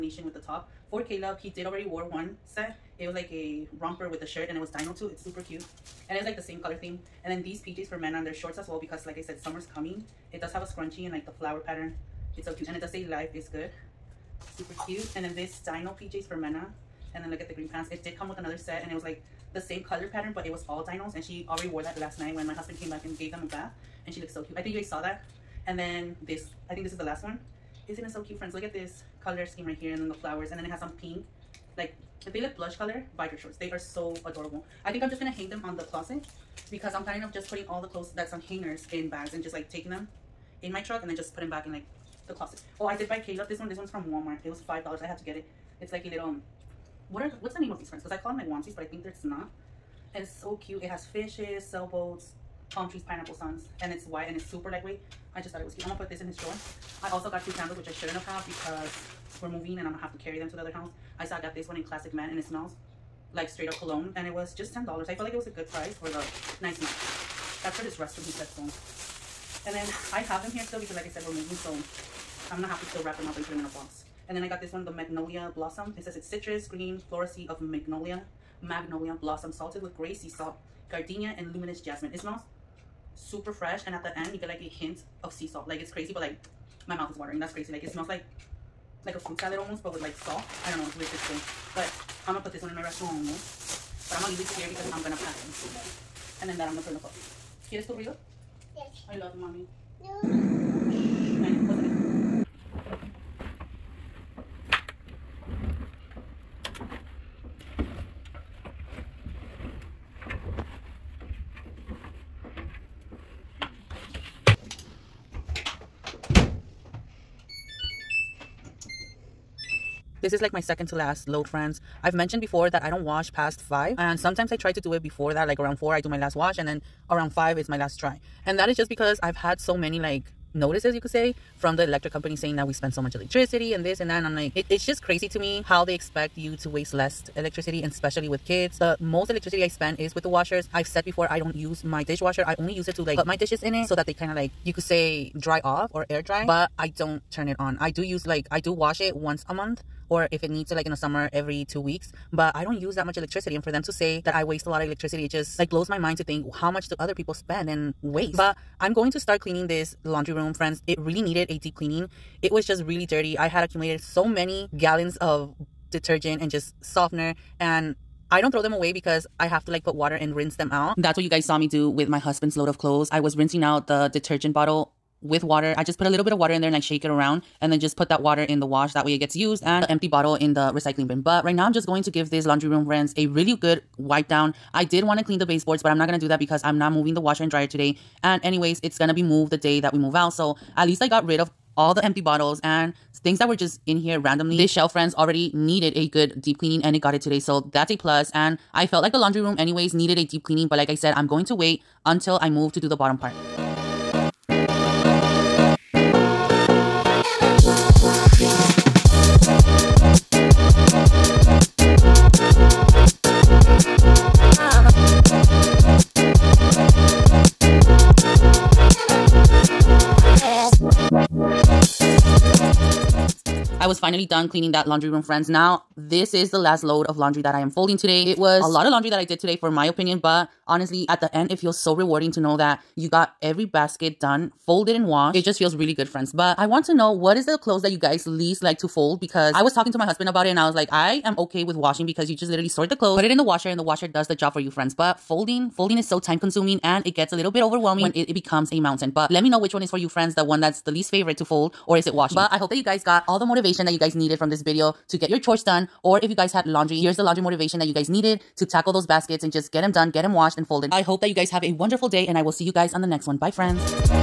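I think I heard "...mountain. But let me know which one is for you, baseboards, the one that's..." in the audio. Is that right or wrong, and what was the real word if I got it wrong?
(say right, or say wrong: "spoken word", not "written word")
wrong: "friends", not "baseboards".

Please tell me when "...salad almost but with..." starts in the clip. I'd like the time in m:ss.
1:29.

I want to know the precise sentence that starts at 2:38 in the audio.
But I'm going to start cleaning this laundry room, friends.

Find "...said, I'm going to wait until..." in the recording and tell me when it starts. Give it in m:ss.
3:20.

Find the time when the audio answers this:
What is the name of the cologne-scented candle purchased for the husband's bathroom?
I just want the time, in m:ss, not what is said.
1:01.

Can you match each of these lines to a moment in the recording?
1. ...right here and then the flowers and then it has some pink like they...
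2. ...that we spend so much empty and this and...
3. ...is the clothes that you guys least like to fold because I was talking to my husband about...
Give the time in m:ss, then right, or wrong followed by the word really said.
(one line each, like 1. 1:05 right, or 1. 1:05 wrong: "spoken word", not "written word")
1. 0:29 right
2. 2:12 wrong: "electricity", not "empty"
3. 3:57 right.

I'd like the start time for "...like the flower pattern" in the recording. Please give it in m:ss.
0:11.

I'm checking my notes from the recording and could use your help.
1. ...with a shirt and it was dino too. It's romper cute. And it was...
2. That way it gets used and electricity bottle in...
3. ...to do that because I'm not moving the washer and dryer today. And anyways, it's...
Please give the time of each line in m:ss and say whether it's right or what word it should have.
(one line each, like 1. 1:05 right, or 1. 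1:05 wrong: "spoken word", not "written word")
1. 0:04 wrong: "super", not "romper"
2. 2:58 wrong: "empty", not "electricity"
3. 3:06 right.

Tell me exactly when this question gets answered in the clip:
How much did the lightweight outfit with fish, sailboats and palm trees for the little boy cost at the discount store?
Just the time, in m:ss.
0:44.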